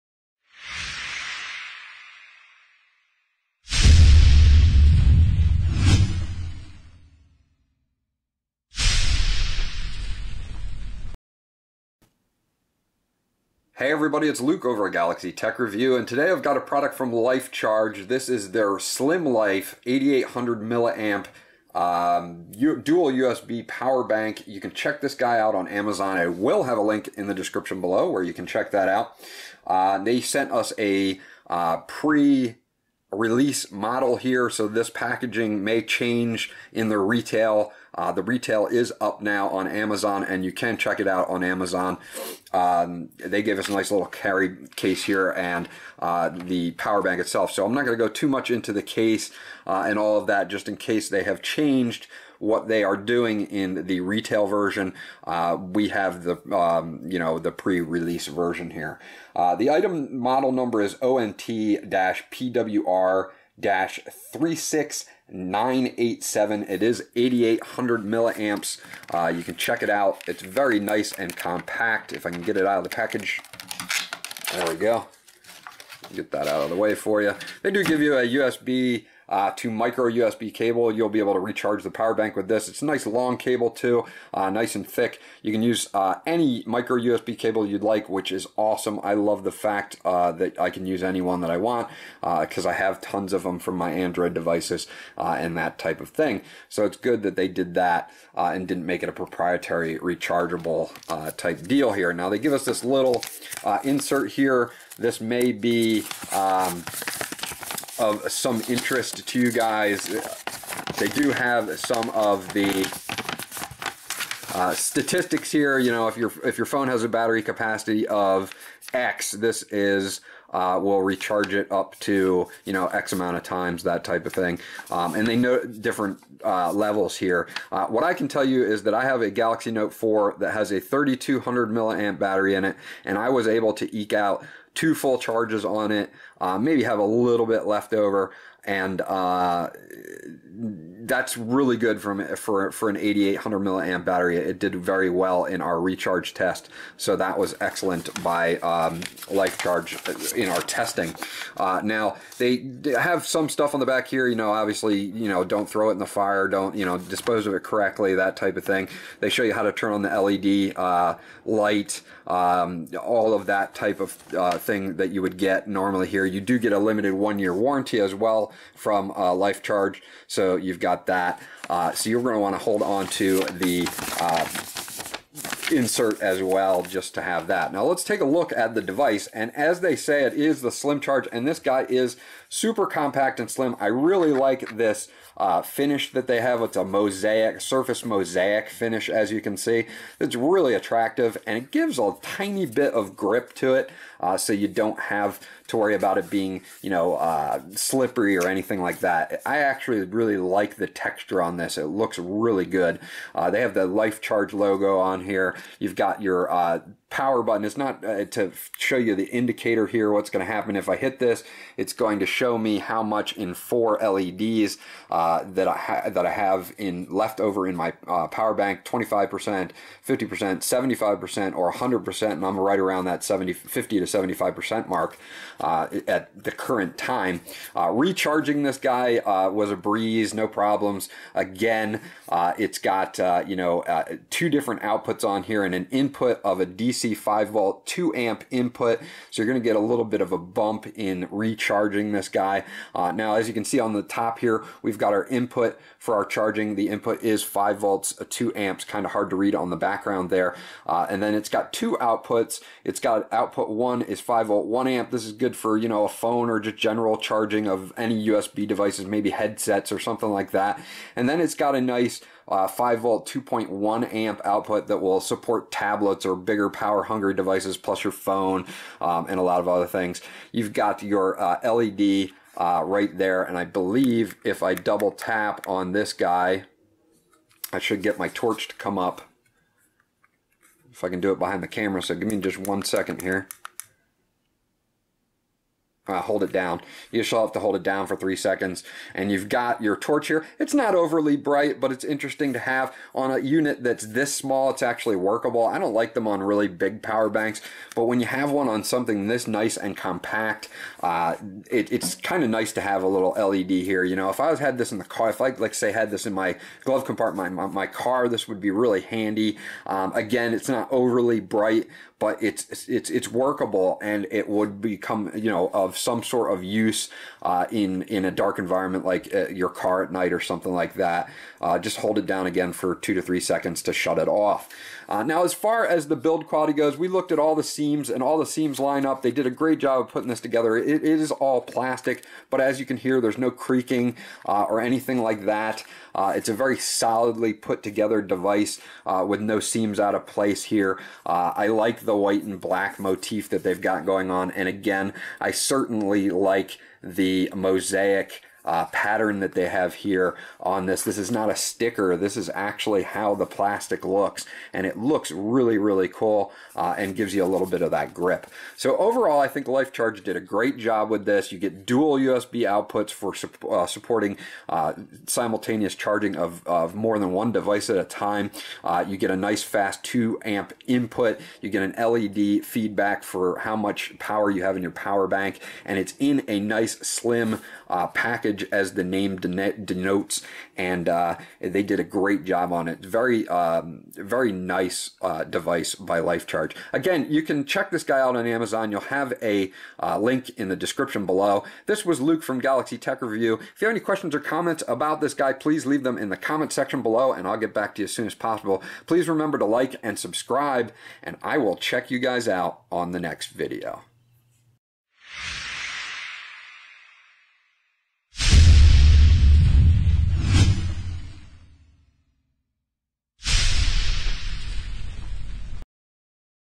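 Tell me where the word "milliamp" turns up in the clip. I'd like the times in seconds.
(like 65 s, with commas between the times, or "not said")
20 s, 68 s, 131 s, 143 s.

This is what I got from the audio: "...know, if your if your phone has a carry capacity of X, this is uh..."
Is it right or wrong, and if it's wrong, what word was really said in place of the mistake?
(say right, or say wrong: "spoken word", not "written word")
wrong: "battery", not "carry".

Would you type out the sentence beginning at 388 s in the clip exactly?
You'll have a uh, link in the description below.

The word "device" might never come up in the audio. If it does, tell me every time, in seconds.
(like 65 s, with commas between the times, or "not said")
94 s, 178 s, 258 s, 267 s, 338 s, 367 s, 385 s.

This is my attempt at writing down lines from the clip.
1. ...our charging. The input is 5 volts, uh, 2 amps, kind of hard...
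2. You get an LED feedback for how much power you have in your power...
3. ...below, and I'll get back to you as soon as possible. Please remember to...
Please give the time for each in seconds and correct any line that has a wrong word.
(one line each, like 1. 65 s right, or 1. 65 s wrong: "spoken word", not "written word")
1. 246 s right
2. 371 s right
3. 397 s right.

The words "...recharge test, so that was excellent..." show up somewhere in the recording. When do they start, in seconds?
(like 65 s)
145 s.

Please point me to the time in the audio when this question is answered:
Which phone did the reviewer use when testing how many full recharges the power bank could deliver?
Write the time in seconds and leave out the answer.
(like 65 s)
129 s.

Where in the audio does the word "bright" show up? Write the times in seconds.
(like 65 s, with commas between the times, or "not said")
291 s, 311 s.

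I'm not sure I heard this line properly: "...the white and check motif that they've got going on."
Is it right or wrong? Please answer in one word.
wrong.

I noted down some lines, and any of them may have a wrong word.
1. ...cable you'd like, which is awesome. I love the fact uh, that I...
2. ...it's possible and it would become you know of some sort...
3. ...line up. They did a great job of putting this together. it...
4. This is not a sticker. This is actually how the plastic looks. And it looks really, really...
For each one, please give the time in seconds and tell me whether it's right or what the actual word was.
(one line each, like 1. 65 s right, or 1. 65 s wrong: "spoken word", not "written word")
1. 87 s right
2. 313 s wrong: "workable", not "possible"
3. 328 s right
4. 351 s right.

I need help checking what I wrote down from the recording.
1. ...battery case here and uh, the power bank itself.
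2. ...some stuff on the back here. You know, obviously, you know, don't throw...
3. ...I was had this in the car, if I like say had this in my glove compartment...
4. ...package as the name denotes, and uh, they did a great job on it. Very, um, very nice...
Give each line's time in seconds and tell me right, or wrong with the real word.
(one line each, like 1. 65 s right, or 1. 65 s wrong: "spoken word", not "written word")
1. 44 s wrong: "carry", not "battery"
2. 153 s right
3. 304 s right
4. 378 s right.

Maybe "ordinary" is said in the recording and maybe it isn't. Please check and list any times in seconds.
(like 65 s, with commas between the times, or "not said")
not said.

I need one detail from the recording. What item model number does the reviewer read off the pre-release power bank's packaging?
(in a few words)
ONT-PWR 36987.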